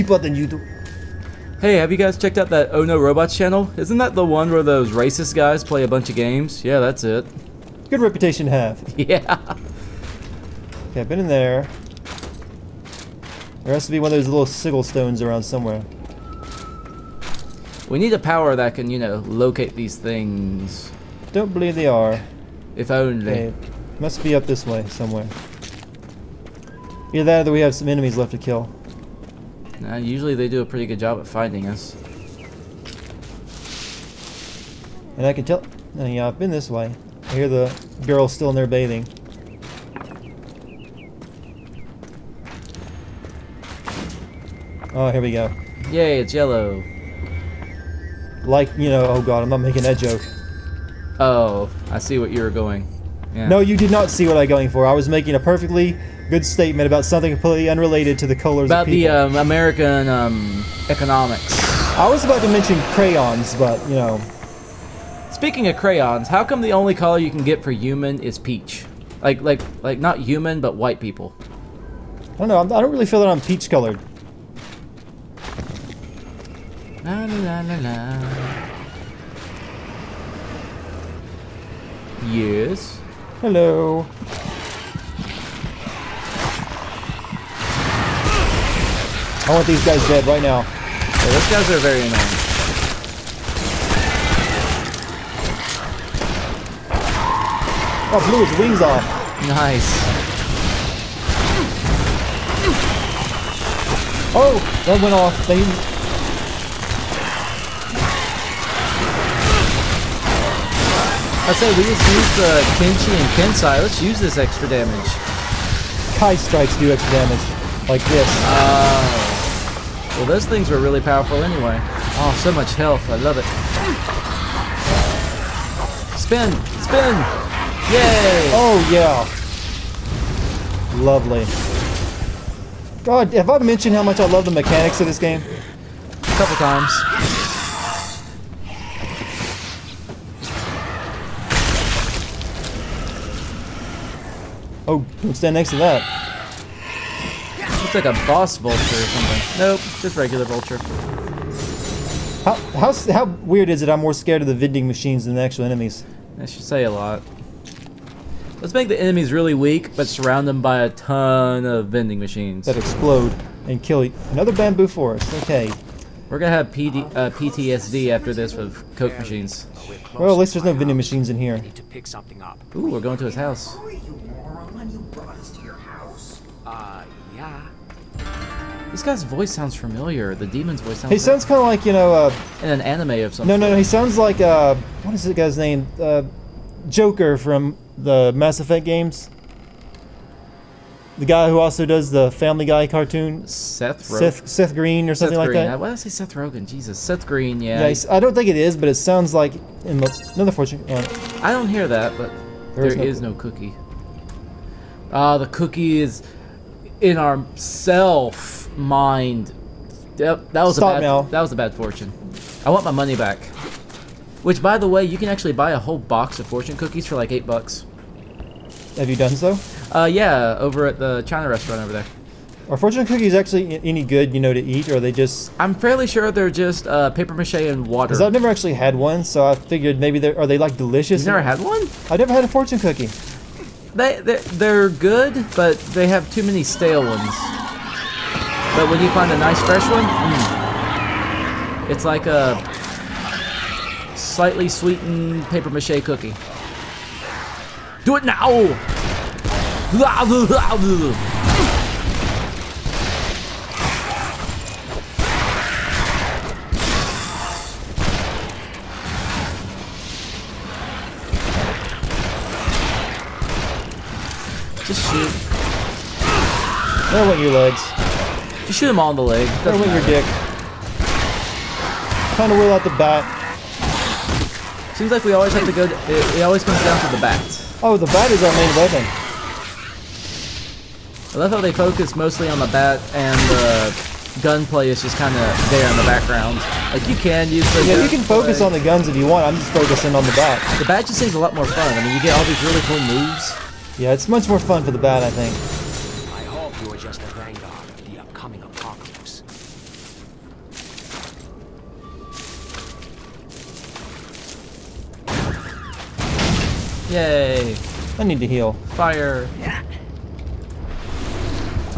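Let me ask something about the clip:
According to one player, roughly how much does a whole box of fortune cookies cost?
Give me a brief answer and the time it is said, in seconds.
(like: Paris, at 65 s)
8 bucks, at 217 s.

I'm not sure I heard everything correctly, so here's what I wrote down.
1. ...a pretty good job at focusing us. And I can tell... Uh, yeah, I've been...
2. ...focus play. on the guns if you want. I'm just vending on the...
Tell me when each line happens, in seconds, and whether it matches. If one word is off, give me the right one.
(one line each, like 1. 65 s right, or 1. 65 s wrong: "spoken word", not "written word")
1. 30 s wrong: "finding", not "focusing"
2. 288 s wrong: "focusing", not "vending".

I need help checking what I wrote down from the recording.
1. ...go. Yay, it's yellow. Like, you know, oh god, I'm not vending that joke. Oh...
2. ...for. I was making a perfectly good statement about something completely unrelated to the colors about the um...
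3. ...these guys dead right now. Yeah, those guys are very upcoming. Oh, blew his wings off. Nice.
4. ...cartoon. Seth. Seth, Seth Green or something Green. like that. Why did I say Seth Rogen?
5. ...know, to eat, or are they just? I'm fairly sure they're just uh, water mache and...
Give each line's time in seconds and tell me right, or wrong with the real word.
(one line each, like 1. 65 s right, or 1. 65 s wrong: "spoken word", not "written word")
1. 45 s wrong: "making", not "vending"
2. 54 s right
3. 89 s wrong: "annoying", not "upcoming"
4. 192 s right
5. 224 s wrong: "paper", not "water".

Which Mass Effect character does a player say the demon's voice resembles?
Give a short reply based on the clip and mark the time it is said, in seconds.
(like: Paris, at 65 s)
Joker, at 186 s.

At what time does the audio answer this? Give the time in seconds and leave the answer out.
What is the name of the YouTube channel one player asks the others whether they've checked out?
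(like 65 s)
2 s.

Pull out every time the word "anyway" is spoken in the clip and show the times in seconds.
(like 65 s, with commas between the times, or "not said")
121 s.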